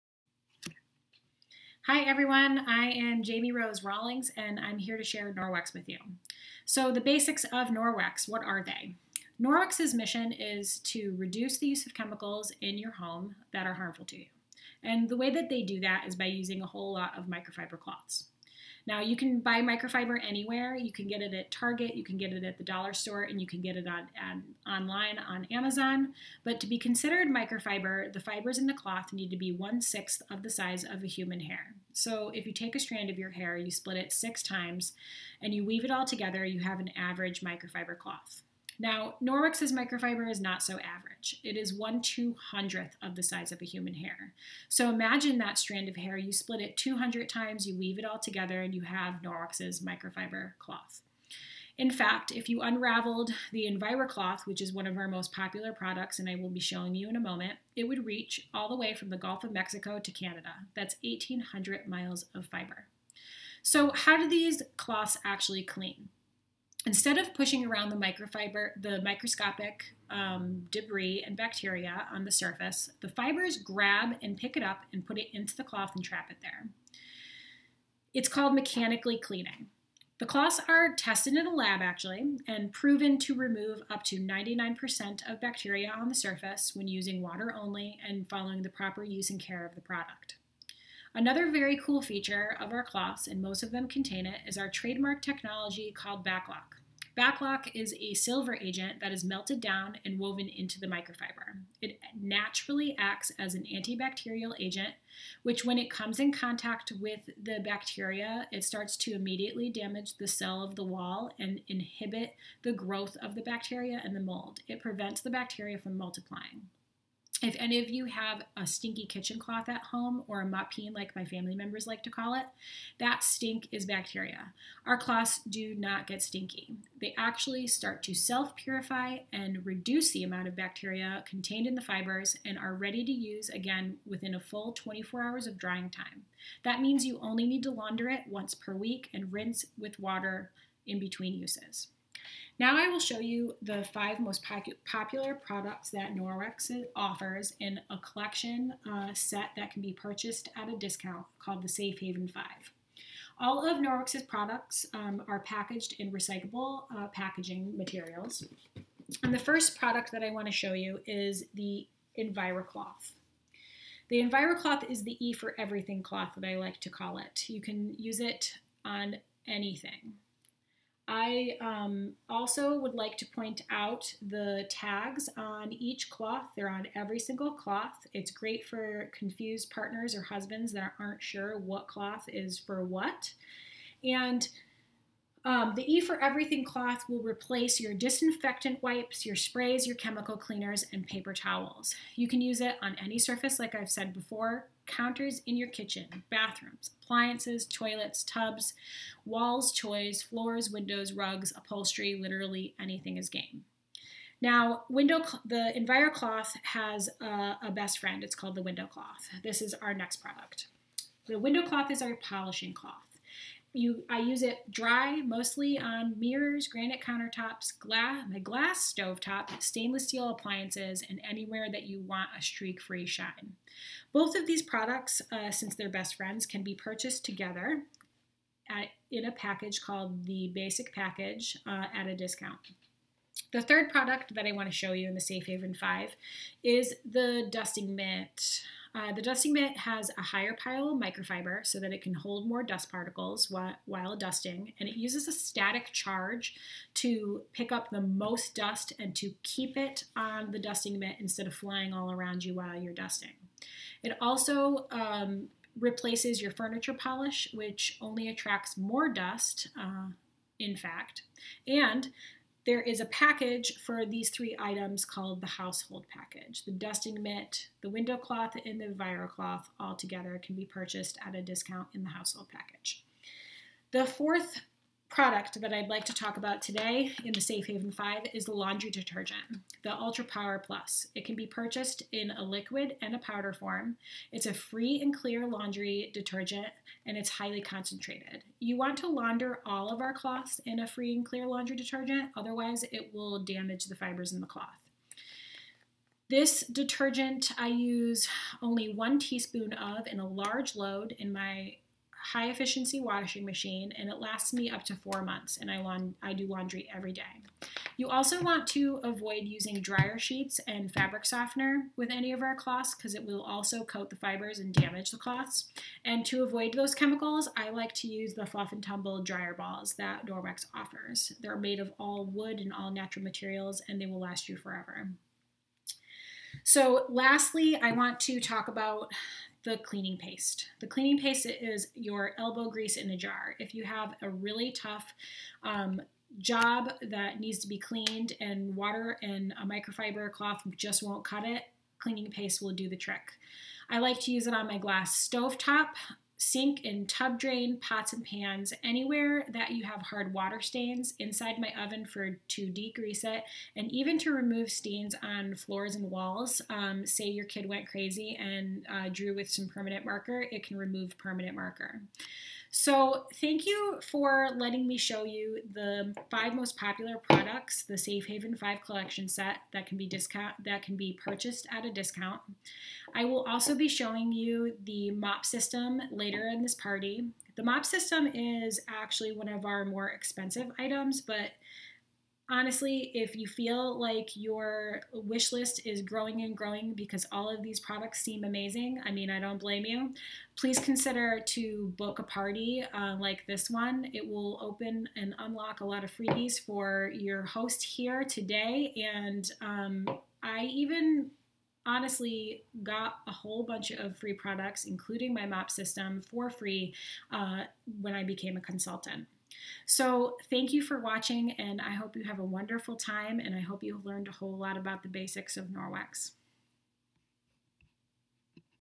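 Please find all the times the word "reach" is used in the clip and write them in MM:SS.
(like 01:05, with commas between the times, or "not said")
00:58.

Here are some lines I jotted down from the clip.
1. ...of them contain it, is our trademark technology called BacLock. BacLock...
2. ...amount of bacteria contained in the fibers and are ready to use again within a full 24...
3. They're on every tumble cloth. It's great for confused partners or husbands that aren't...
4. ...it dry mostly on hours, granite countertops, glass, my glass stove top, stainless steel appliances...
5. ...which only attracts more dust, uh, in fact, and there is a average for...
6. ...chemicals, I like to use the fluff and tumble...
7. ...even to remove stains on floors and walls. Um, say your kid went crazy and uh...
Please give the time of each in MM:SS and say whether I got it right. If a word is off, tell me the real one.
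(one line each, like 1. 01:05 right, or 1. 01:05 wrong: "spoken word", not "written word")
1. 01:33 right
2. 02:10 right
3. 02:56 wrong: "single", not "tumble"
4. 03:34 wrong: "mirrors", not "hours"
5. 04:17 wrong: "package", not "average"
6. 05:16 right
7. 05:53 right.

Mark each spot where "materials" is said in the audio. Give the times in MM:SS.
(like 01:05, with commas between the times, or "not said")
02:37, 05:23.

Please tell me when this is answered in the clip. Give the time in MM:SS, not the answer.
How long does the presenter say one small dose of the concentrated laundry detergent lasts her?
05:04.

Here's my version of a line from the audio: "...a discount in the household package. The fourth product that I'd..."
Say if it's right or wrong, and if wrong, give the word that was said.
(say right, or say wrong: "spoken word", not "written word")
right.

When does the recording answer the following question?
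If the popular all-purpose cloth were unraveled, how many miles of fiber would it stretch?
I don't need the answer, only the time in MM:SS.
01:01.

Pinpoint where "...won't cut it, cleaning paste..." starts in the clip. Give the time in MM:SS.
05:41.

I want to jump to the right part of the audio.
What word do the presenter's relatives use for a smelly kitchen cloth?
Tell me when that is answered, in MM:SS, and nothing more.
02:00.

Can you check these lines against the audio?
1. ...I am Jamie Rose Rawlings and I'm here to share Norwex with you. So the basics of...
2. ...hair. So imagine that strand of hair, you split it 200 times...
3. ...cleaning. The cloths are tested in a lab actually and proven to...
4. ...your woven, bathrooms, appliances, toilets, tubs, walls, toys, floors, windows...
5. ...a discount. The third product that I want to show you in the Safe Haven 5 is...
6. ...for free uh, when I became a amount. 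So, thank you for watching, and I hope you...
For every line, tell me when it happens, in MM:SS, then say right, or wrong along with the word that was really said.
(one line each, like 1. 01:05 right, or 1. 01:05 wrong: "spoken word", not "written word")
1. 00:02 right
2. 00:43 right
3. 01:19 right
4. 03:15 wrong: "kitchen", not "woven"
5. 03:52 right
6. 06:46 wrong: "consultant", not "amount".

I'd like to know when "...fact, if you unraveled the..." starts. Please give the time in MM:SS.
00:51.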